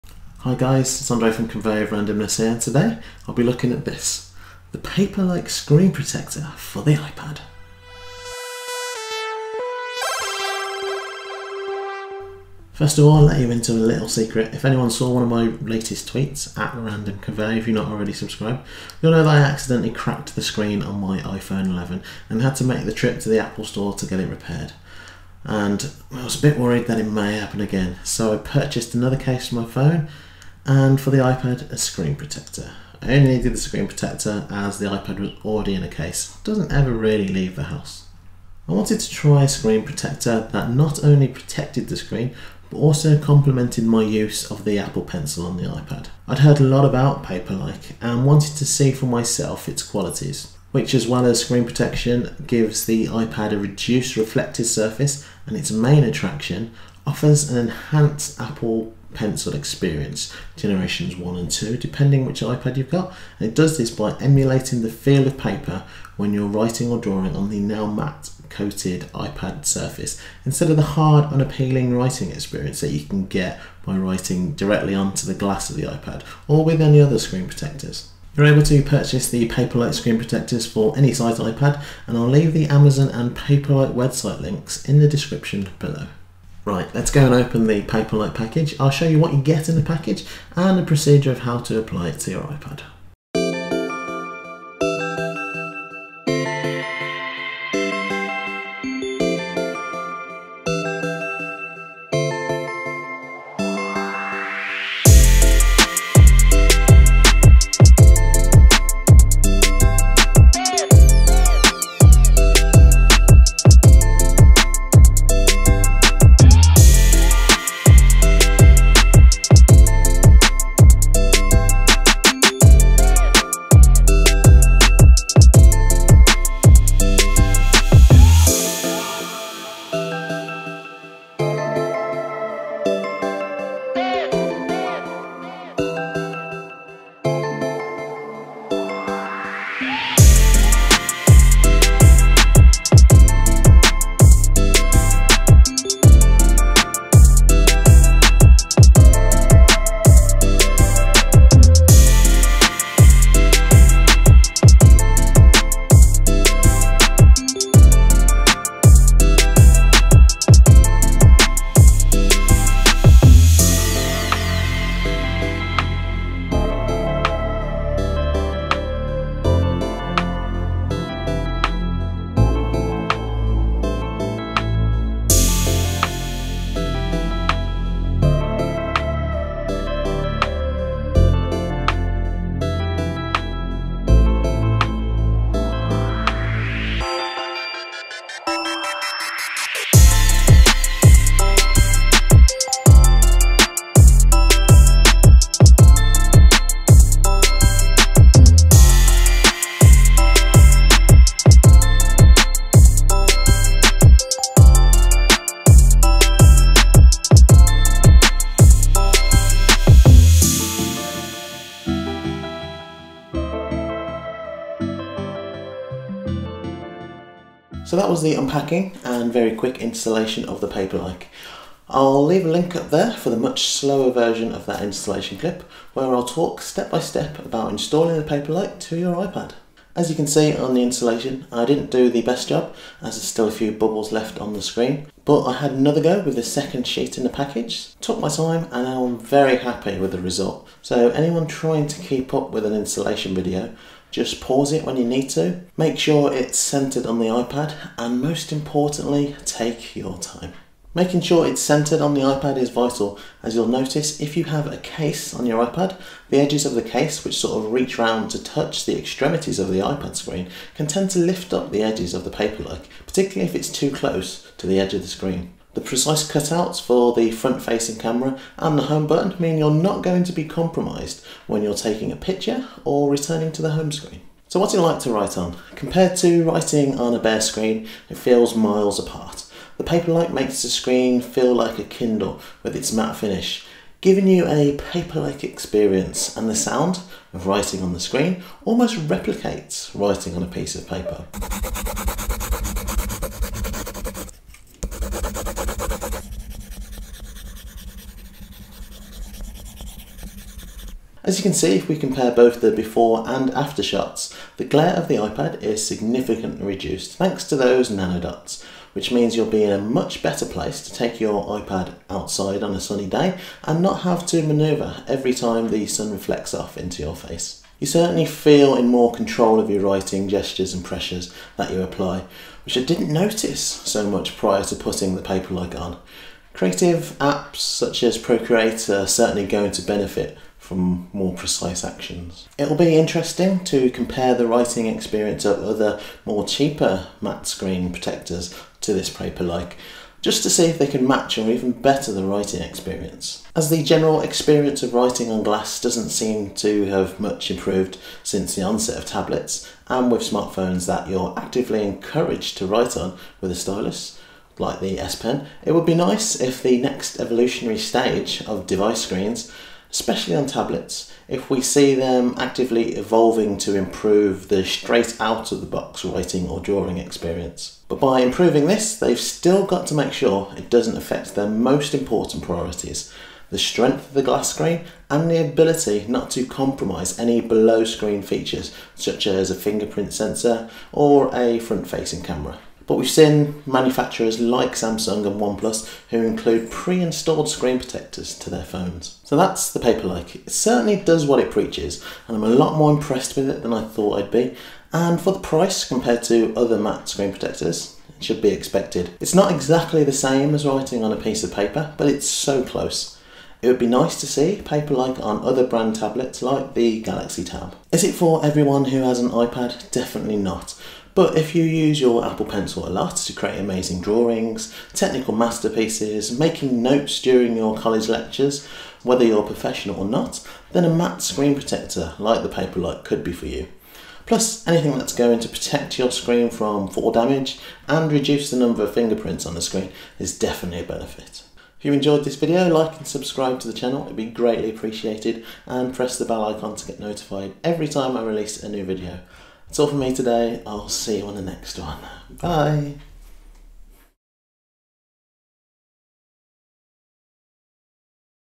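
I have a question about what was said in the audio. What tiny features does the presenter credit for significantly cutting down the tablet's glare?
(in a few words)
nanodots.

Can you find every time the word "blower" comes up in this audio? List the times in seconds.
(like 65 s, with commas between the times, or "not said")
not said.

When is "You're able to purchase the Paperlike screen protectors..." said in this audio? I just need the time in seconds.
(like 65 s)
78 s.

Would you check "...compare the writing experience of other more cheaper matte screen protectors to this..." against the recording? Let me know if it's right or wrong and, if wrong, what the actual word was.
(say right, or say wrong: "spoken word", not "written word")
right.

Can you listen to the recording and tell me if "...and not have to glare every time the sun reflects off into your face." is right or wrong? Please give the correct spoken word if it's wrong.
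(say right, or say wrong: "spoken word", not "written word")
wrong: "manoeuvre", not "glare".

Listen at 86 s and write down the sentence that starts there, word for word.
Right, let's go and open the Paperlike package.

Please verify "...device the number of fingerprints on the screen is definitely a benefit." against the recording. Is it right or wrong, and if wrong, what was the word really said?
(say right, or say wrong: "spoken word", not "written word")
wrong: "reduce", not "device".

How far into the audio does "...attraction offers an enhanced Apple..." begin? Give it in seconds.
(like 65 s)
56 s.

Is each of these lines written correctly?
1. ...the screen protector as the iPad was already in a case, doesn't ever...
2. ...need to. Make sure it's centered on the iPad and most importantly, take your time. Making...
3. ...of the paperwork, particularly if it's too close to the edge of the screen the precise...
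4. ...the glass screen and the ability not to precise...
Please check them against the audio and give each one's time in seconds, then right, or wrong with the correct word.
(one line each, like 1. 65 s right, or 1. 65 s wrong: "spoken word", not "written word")
1. 33 s right
2. 245 s right
3. 262 s right
4. 374 s wrong: "compromise", not "precise".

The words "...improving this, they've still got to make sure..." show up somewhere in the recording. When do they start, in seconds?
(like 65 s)
368 s.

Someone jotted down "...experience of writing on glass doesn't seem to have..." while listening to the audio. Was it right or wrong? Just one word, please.
right.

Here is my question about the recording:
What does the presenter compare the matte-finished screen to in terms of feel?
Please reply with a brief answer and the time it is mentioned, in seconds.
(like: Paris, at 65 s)
Kindle, at 281 s.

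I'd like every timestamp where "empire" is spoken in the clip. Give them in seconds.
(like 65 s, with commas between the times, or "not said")
not said.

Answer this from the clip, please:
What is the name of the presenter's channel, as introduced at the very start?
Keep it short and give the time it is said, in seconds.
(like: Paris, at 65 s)
Conveyor of Randomness, at 1 s.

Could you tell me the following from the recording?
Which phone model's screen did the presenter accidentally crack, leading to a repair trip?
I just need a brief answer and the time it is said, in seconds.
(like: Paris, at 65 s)
iPhone 11, at 21 s.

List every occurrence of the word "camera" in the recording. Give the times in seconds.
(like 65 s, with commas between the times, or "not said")
267 s, 382 s.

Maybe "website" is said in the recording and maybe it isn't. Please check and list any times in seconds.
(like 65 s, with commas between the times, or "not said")
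83 s.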